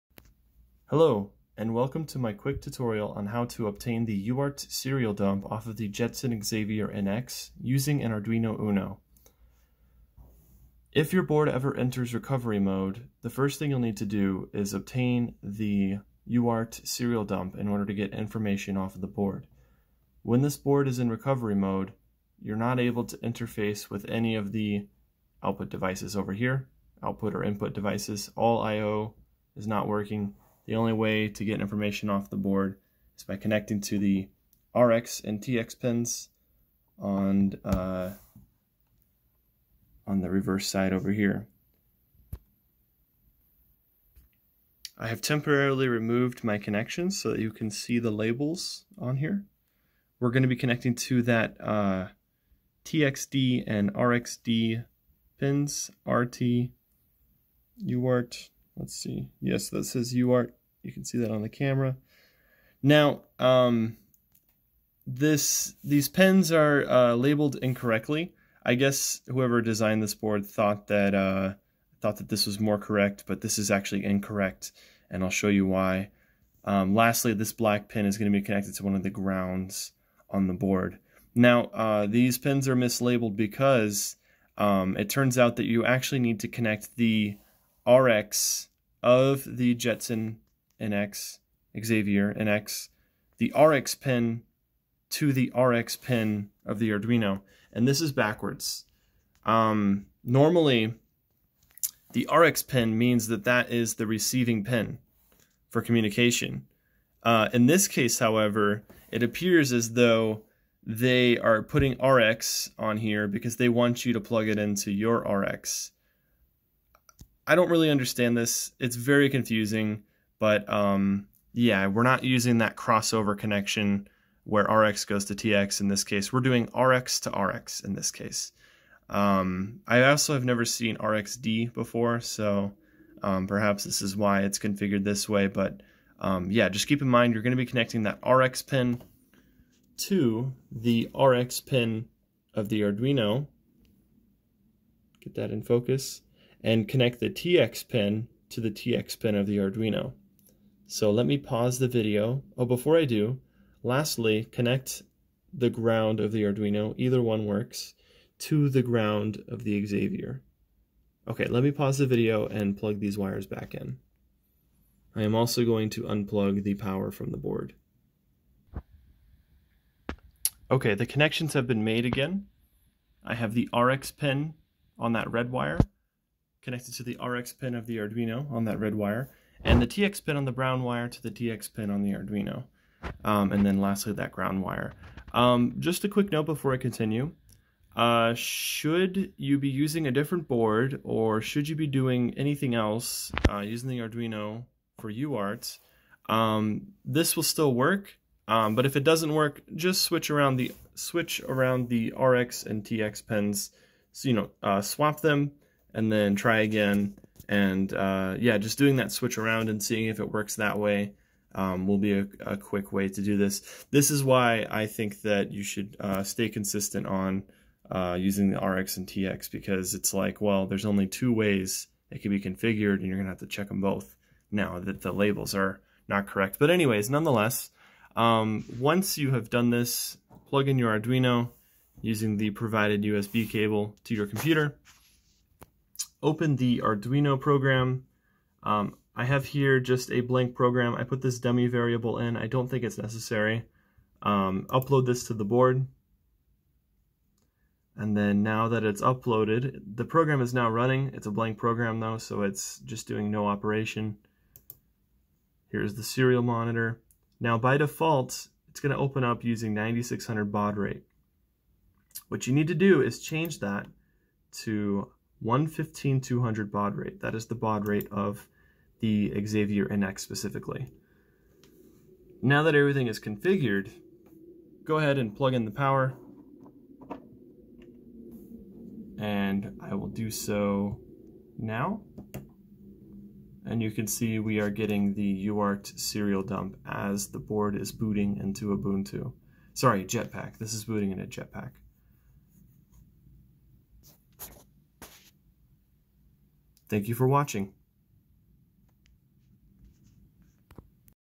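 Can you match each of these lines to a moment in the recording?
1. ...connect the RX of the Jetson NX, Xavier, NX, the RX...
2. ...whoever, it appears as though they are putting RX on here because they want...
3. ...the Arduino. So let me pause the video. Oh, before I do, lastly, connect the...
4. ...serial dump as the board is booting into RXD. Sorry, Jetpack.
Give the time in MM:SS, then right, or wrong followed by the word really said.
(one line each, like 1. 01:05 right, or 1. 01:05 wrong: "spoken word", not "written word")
1. 01:26 right
2. 01:48 wrong: "however", not "whoever"
3. 02:29 right
4. 04:45 wrong: "Ubuntu", not "RXD".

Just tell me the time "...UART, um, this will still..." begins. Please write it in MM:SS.
03:15.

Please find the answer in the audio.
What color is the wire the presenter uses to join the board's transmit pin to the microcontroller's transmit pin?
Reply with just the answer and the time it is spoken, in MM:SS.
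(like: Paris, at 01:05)
brown, at 03:00.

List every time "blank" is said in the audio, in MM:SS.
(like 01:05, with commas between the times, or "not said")
04:00, 04:11.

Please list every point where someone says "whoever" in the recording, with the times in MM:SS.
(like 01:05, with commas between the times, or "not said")
01:09.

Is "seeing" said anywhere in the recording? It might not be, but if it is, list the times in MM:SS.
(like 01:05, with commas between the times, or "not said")
03:29.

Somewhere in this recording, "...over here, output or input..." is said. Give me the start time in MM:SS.
00:26.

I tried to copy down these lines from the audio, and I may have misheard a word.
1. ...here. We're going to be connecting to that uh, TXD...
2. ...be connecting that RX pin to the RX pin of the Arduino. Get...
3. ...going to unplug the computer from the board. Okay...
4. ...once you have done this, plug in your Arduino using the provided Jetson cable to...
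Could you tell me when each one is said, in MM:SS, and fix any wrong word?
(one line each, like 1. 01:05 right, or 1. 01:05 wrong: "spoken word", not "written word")
1. 00:49 right
2. 02:17 right
3. 02:45 wrong: "power", not "computer"
4. 03:48 wrong: "USB", not "Jetson".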